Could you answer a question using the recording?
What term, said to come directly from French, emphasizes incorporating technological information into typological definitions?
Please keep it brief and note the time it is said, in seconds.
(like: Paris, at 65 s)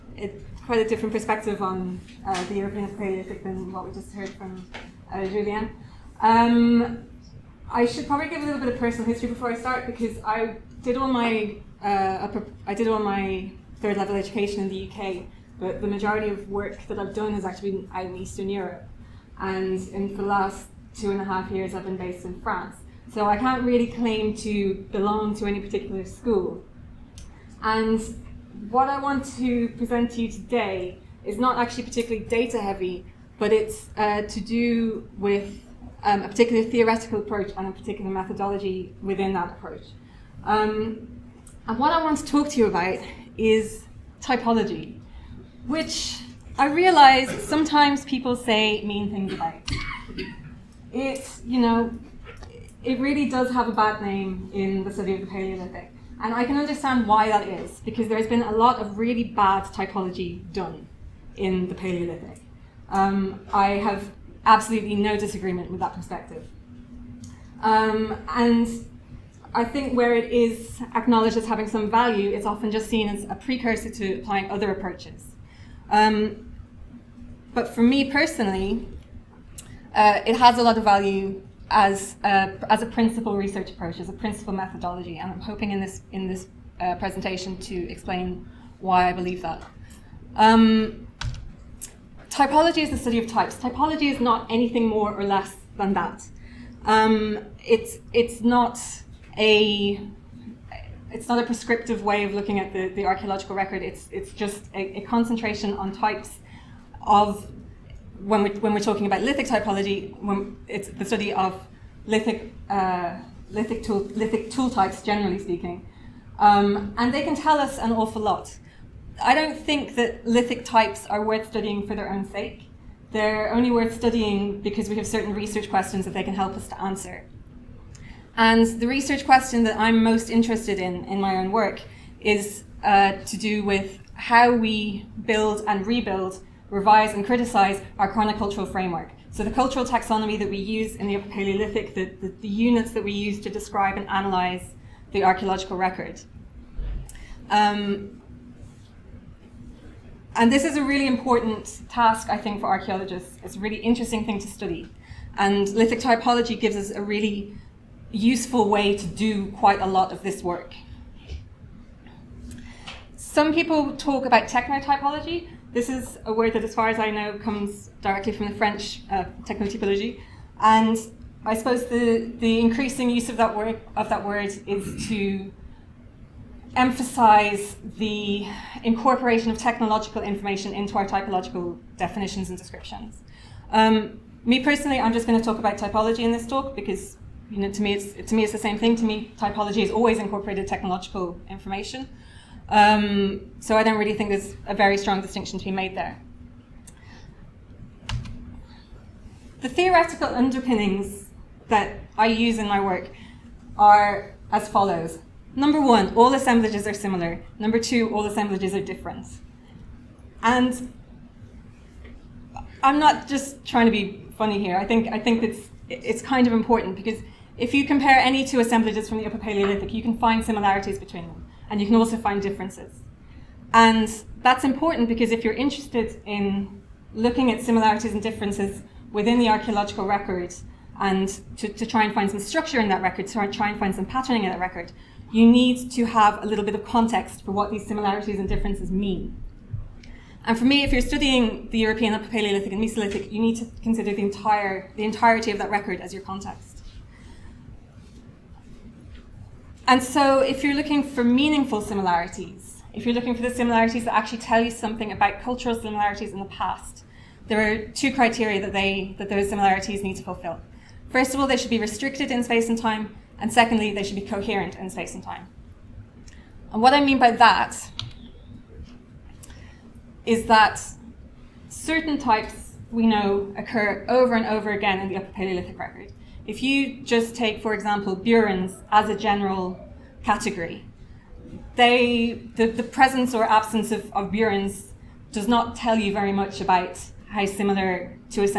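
techno typology, at 164 s.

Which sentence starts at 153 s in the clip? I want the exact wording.
It's a really interesting thing to study.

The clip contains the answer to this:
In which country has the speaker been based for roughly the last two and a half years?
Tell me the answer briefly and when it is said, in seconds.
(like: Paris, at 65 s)
France, at 22 s.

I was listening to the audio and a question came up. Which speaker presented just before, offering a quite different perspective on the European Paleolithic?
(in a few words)
Julian.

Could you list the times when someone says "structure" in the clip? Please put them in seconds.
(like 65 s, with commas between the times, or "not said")
232 s.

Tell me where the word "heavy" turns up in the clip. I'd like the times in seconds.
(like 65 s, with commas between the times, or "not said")
32 s.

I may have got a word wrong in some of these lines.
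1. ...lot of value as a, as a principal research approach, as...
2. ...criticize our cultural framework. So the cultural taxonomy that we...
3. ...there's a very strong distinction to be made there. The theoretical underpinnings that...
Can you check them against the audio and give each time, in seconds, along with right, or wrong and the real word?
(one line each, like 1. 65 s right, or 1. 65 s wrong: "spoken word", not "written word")
1. 80 s right
2. 137 s wrong: "chronocultural", not "cultural"
3. 194 s right.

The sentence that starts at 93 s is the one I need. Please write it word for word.
Typology is not anything more or less than that.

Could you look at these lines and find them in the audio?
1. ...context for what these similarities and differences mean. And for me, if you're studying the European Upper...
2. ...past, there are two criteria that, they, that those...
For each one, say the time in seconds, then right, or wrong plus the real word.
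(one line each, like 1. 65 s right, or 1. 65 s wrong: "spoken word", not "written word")
1. 236 s right
2. 256 s right.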